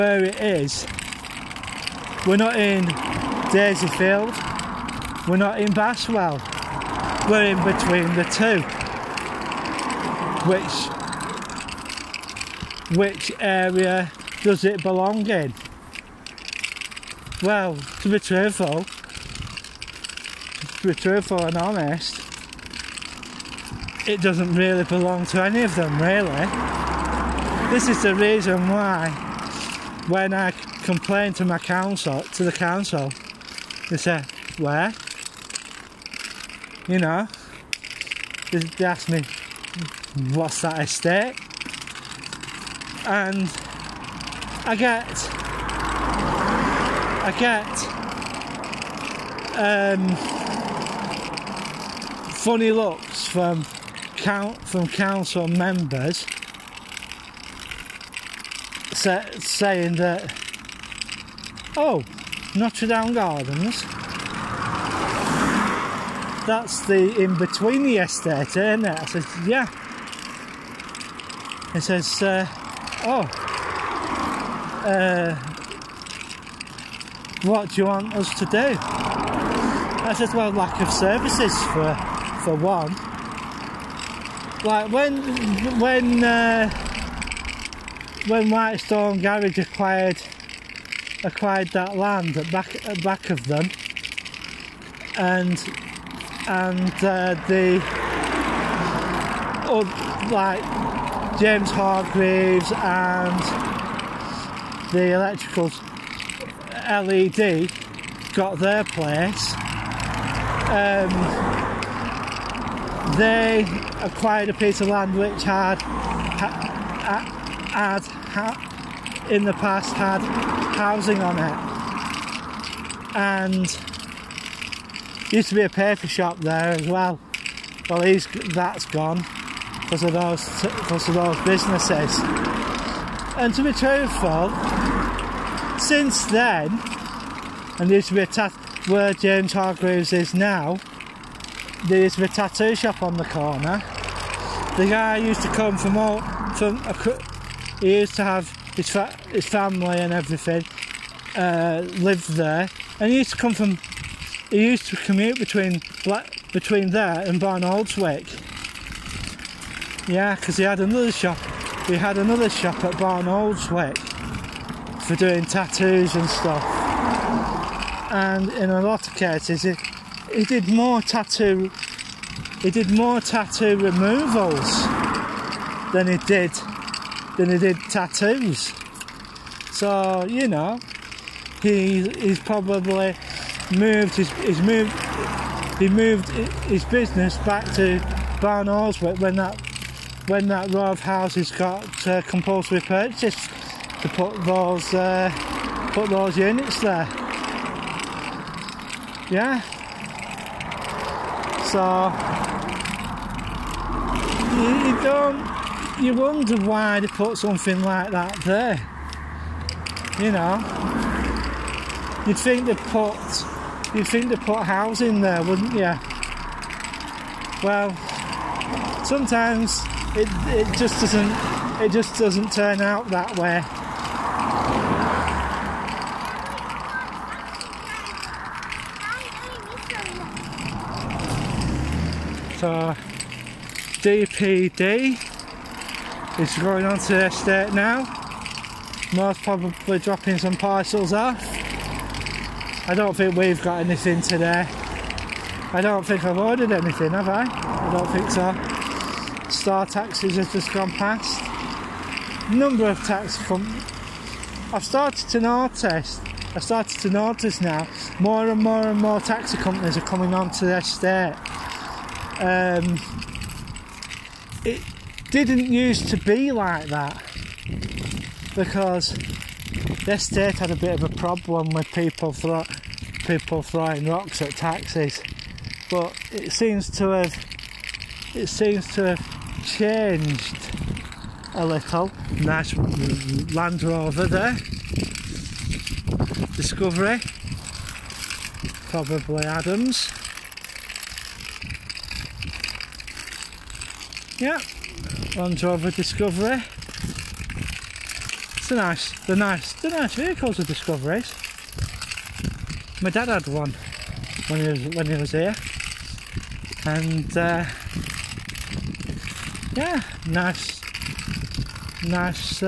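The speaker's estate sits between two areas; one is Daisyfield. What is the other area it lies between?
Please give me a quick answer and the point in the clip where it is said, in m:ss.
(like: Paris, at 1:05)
Bastwell, at 0:05.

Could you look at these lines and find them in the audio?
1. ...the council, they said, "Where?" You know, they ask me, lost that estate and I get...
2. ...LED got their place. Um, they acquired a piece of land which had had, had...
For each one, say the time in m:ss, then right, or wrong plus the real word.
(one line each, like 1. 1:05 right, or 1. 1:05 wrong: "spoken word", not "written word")
1. 0:32 right
2. 1:46 right.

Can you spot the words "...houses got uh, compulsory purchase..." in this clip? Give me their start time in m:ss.
3:10.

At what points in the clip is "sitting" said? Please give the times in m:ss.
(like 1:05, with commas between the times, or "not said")
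not said.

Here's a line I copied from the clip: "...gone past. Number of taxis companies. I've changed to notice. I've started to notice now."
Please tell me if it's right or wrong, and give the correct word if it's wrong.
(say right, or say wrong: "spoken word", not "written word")
wrong: "started", not "changed".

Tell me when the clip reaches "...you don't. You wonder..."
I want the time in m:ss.
3:24.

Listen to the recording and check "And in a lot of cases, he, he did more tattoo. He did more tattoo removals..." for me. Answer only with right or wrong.
right.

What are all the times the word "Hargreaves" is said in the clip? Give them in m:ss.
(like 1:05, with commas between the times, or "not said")
1:41, 2:19.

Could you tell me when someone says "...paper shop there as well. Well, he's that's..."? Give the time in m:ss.
2:05.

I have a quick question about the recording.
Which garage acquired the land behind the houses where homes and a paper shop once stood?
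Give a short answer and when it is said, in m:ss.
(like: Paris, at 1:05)
Whitestone Garage, at 1:28.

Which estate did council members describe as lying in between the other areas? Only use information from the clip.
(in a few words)
Notre Dame Gardens.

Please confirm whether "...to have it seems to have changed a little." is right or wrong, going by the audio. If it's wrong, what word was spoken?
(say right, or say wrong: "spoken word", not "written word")
right.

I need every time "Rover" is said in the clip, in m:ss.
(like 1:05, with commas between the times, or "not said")
4:43, 4:55.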